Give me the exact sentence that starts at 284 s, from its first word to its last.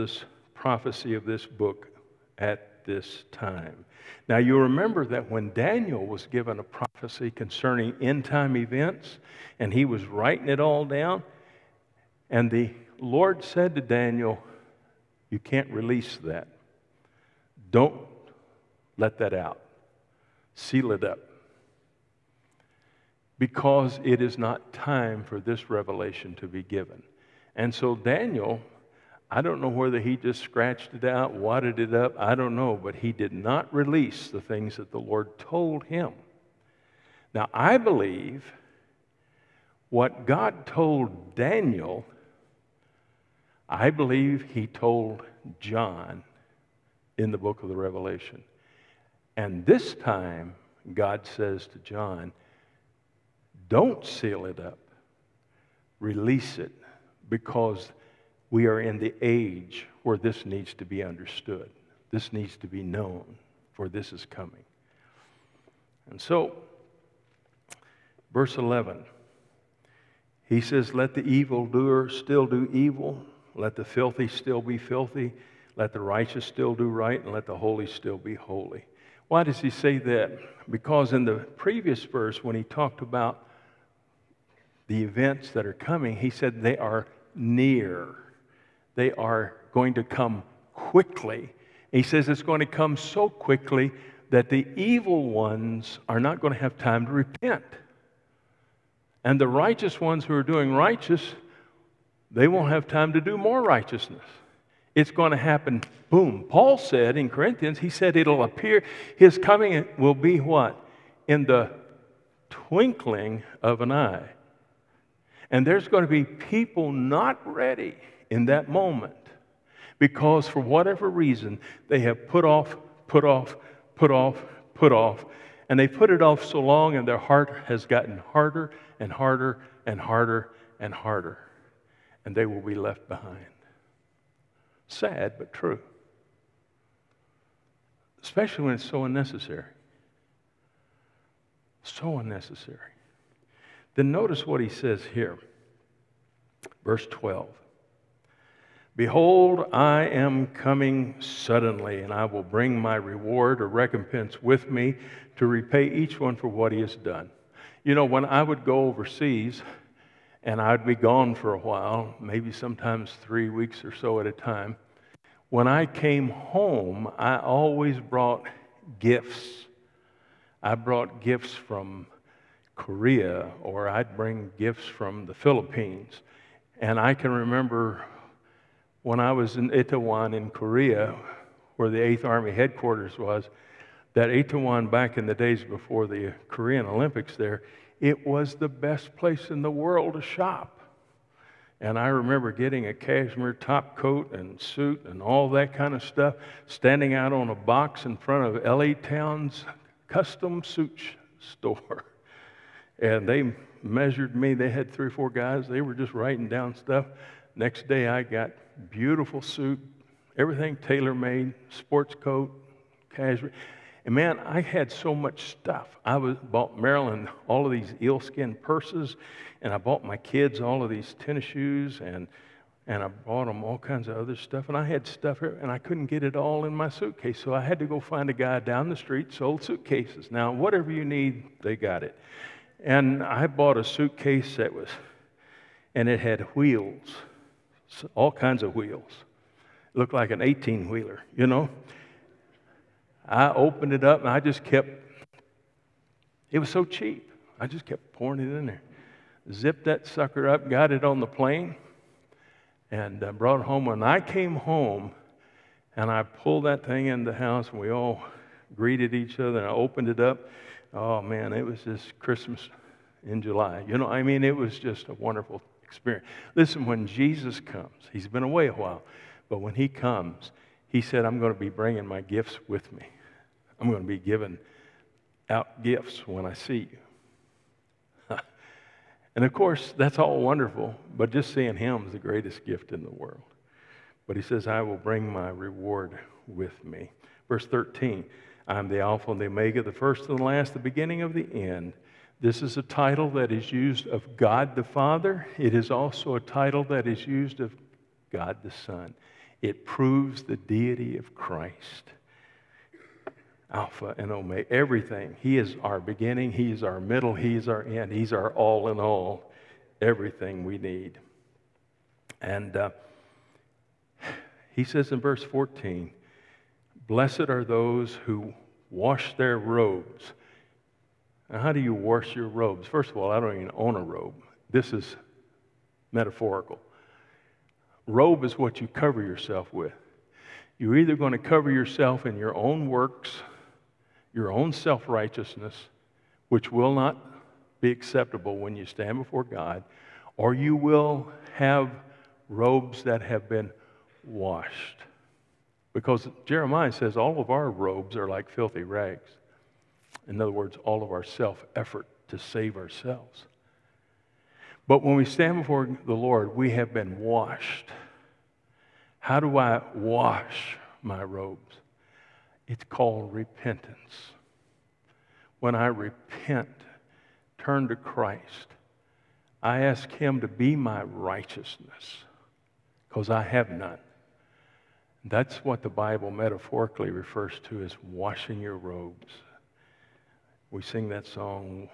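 But he says, I will bring my reward with me.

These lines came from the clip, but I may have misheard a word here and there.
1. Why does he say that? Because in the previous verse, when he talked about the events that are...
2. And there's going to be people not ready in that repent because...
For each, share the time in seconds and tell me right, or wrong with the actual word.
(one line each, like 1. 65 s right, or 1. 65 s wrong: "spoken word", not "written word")
1. 79 s right
2. 115 s wrong: "moment", not "repent".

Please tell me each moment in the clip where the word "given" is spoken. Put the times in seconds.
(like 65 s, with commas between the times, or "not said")
6 s, 26 s.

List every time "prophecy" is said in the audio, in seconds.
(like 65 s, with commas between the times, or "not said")
0 s, 6 s.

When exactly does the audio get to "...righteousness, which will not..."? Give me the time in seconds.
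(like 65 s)
335 s.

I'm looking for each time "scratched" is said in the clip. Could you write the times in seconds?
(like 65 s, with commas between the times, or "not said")
30 s.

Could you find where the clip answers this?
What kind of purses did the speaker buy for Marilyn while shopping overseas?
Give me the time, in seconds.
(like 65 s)
218 s.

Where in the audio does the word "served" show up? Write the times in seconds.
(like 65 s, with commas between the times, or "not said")
not said.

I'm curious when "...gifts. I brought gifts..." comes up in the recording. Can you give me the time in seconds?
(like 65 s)
168 s.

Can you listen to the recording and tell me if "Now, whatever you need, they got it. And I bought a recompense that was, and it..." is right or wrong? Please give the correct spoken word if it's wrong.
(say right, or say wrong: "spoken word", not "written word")
wrong: "suitcase", not "recompense".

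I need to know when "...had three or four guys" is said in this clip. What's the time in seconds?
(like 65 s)
204 s.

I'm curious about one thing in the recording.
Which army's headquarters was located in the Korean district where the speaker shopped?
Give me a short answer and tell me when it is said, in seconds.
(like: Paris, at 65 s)
8th Army, at 181 s.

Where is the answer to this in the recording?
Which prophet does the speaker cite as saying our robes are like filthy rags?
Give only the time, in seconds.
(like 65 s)
346 s.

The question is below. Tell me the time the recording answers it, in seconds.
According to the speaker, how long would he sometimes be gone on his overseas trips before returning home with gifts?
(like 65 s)
163 s.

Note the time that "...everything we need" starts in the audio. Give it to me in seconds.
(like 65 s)
310 s.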